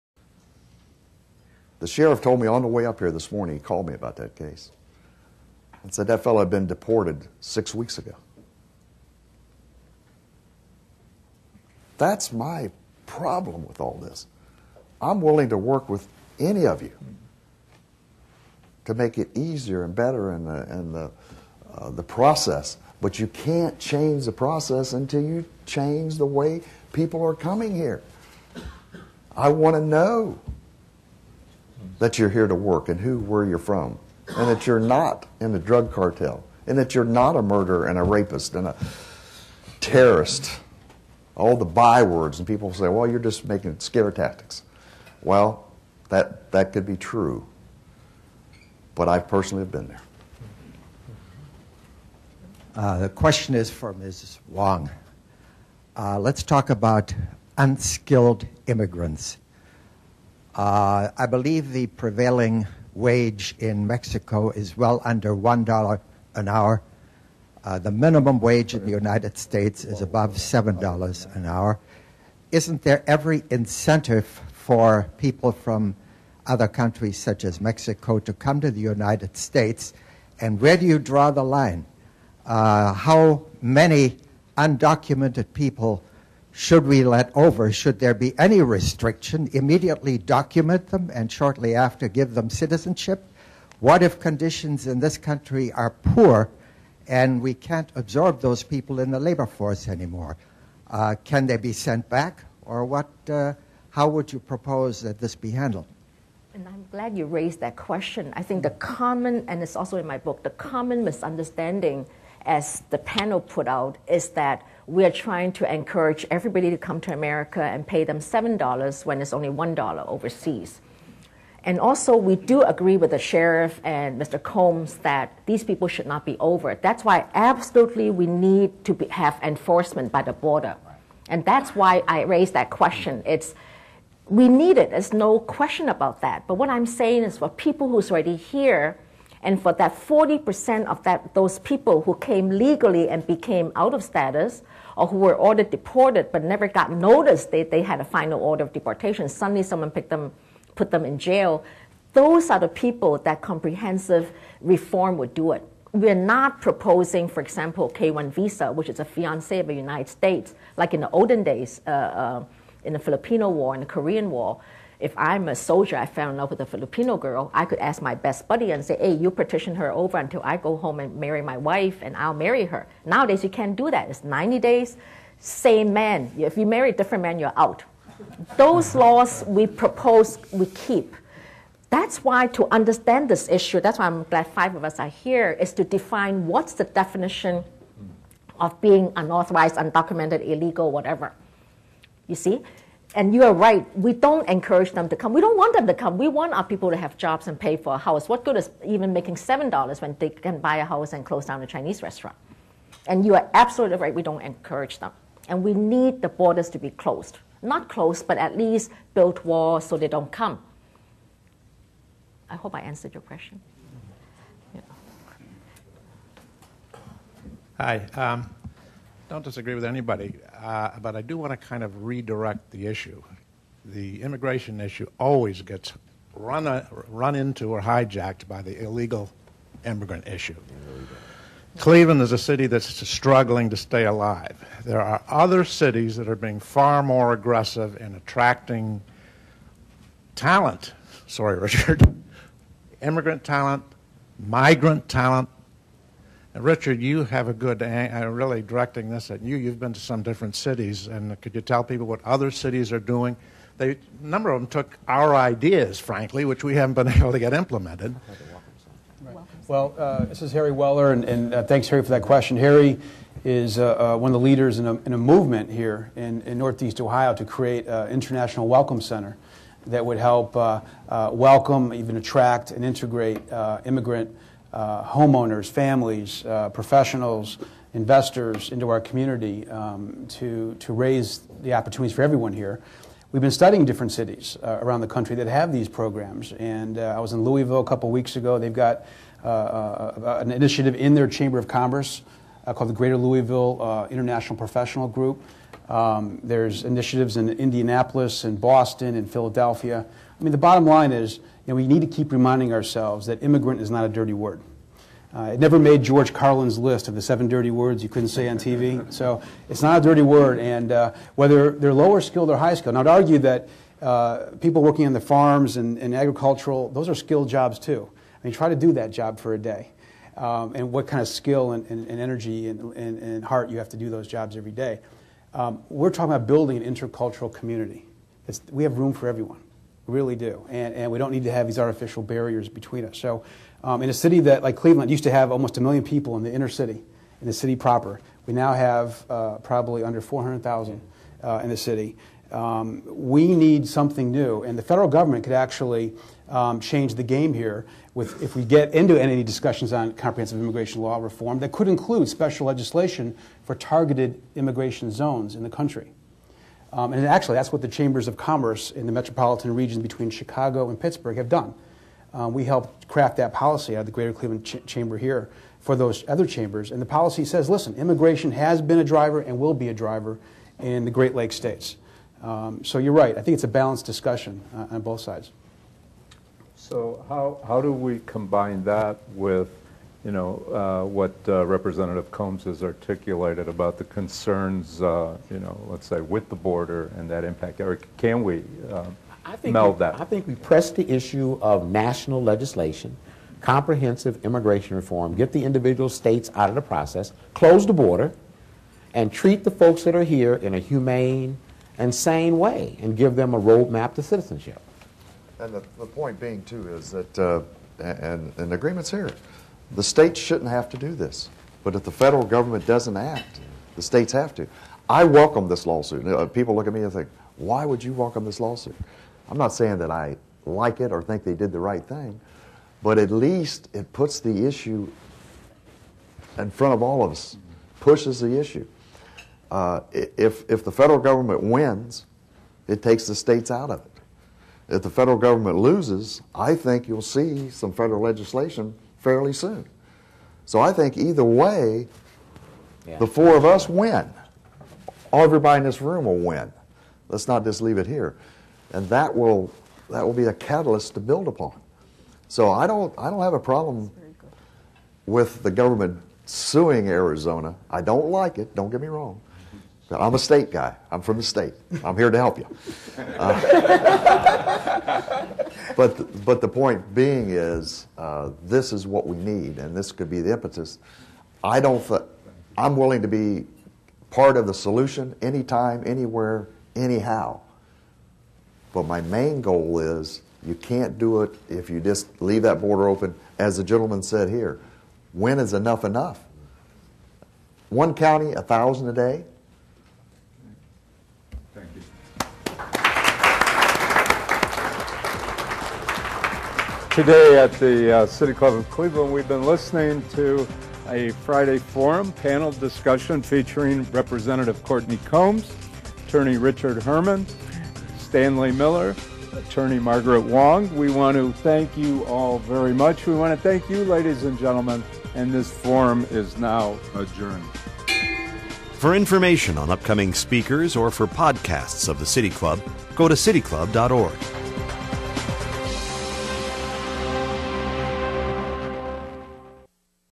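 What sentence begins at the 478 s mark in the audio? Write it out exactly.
But my main goal is you can't do it if you just leave that border open.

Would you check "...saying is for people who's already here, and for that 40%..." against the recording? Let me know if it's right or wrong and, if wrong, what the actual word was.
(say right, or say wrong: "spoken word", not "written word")
right.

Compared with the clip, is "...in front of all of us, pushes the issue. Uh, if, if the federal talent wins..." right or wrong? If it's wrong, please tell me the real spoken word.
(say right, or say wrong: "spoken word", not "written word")
wrong: "government", not "talent".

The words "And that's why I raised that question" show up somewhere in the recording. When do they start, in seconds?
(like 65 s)
131 s.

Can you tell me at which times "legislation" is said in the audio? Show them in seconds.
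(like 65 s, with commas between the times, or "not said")
352 s, 392 s, 438 s.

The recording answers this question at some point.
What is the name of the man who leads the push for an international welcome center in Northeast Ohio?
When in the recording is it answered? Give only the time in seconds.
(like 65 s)
260 s.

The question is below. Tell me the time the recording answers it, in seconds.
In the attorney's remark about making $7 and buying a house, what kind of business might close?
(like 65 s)
201 s.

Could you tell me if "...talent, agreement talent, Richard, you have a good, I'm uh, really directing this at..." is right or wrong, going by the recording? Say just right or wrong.
wrong.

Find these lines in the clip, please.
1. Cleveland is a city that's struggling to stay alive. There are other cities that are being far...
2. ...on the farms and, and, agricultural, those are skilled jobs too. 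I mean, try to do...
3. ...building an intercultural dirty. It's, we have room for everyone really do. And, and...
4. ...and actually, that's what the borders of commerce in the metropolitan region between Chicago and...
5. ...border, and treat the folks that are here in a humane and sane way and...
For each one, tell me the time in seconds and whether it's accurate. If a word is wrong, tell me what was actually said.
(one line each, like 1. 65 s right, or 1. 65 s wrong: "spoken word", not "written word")
1. 231 s right
2. 315 s right
3. 326 s wrong: "community", not "dirty"
4. 357 s wrong: "chambers", not "borders"
5. 397 s right.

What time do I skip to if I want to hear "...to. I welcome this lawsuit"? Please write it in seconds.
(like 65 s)
414 s.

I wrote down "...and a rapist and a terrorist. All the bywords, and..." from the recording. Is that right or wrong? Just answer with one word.
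right.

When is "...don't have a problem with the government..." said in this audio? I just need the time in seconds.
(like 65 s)
453 s.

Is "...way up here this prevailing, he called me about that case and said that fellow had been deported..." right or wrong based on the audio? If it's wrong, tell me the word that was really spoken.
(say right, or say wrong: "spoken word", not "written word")
wrong: "morning", not "prevailing".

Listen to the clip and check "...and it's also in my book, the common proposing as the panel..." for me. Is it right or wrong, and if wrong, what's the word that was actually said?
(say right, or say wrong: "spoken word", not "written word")
wrong: "misunderstanding", not "proposing".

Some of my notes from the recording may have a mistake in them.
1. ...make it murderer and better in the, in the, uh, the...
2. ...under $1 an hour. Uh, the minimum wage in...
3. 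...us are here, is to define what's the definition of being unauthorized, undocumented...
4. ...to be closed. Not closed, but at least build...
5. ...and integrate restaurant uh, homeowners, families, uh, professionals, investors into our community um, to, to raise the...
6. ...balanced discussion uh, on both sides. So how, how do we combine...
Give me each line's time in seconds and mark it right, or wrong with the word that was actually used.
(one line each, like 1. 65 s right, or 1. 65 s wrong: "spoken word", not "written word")
1. 18 s wrong: "easier", not "murderer"
2. 65 s right
3. 184 s right
4. 206 s right
5. 272 s wrong: "immigrant", not "restaurant"
6. 373 s right.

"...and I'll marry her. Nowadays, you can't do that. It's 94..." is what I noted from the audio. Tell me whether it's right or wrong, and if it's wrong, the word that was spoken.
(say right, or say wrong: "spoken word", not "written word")
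wrong: "90", not "94".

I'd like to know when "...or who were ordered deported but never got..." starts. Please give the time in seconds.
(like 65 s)
144 s.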